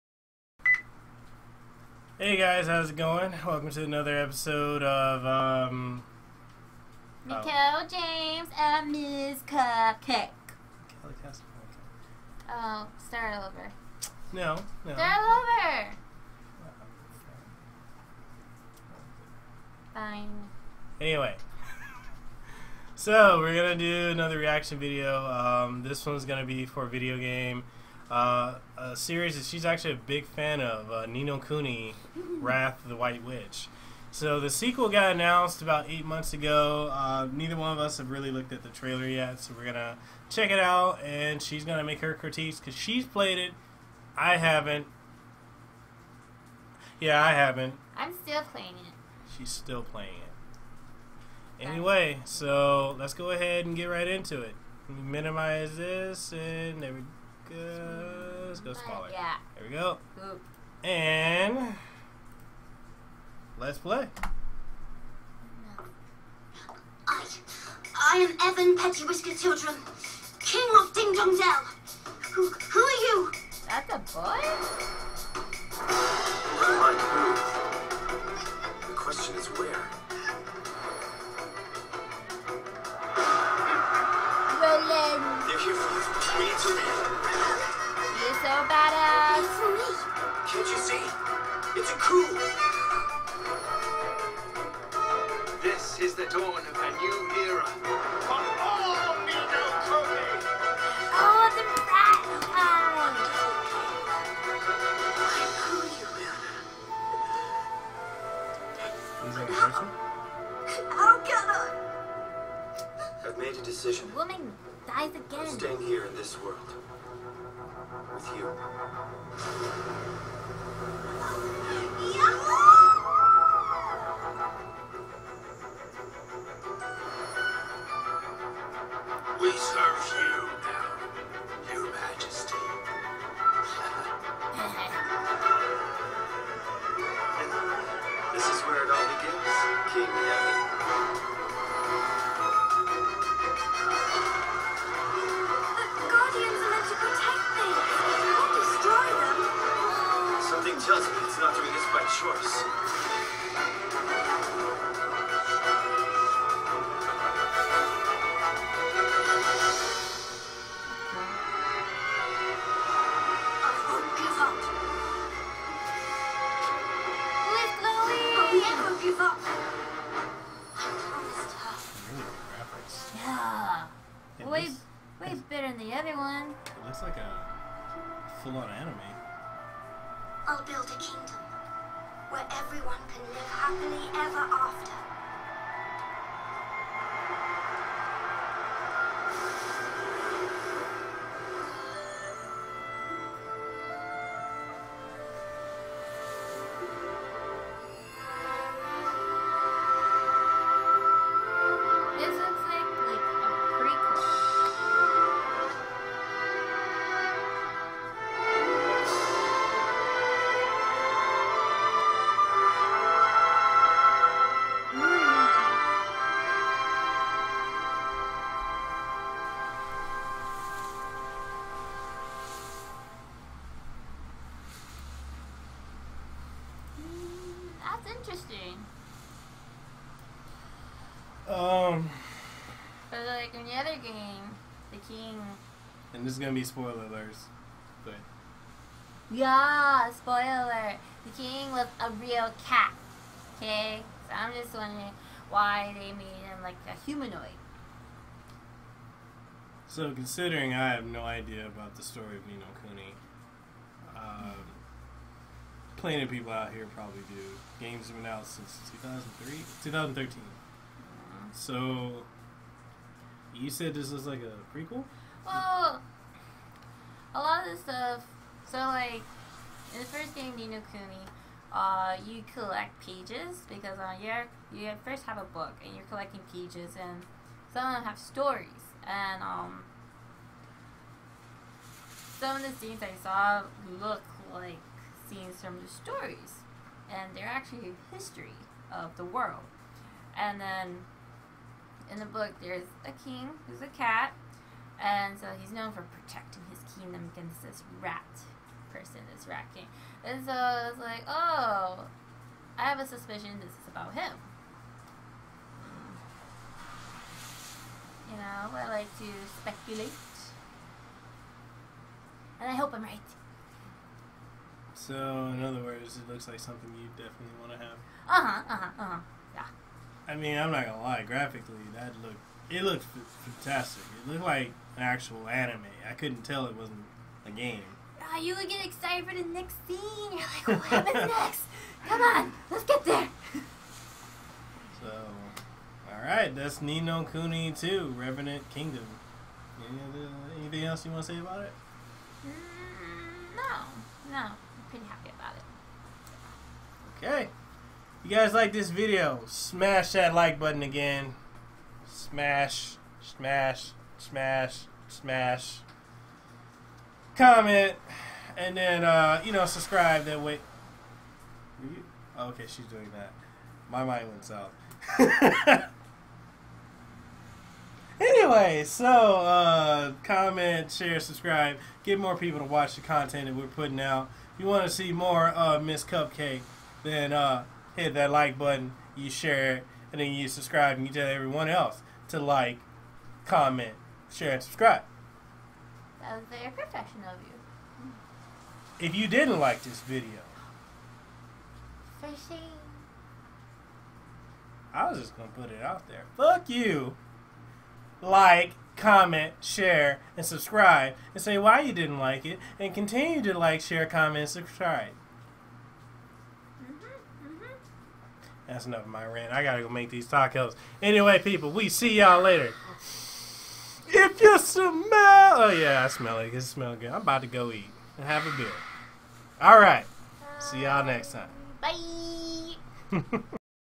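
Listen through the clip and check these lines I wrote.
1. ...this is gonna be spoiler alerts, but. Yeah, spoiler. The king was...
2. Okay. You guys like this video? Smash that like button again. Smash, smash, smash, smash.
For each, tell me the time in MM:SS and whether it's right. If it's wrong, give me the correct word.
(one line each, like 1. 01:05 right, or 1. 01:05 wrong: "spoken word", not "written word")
1. 03:56 right
2. 05:47 right.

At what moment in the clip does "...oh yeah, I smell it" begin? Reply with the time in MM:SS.
06:55.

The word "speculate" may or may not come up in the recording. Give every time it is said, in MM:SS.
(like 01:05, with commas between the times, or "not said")
05:09.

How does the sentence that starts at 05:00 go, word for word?
And so it's like, oh, I have a suspicion this is about him.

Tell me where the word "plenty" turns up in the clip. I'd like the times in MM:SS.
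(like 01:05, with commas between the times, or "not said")
04:15.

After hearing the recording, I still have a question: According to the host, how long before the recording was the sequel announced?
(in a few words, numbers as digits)
8 months.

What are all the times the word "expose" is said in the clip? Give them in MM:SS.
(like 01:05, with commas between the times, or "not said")
not said.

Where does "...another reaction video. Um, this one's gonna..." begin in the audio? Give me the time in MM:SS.
00:24.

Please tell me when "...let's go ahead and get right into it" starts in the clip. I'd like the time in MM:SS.
00:52.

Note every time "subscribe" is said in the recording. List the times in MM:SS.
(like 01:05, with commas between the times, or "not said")
05:59, 06:11, 06:20, 06:24, 06:40, 06:44.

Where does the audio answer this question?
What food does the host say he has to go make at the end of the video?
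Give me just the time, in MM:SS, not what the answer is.
06:50.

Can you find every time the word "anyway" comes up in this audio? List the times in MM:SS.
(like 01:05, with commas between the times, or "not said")
00:21, 00:51, 06:08, 06:51.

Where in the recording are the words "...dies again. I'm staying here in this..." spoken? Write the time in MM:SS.
01:54.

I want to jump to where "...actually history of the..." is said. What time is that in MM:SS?
04:47.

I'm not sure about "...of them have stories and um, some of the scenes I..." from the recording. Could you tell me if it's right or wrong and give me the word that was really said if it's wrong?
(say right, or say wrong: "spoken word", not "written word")
right.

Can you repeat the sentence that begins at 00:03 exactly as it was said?
Welcome to another episode of um Nicole oh.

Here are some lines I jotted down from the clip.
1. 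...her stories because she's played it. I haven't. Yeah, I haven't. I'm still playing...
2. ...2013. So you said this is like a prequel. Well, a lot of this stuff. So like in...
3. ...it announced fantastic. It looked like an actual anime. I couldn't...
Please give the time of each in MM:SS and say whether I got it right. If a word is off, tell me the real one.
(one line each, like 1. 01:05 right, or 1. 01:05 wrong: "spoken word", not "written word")
1. 00:42 wrong: "critiques", not "stories"
2. 04:19 right
3. 05:22 wrong: "looked", not "announced".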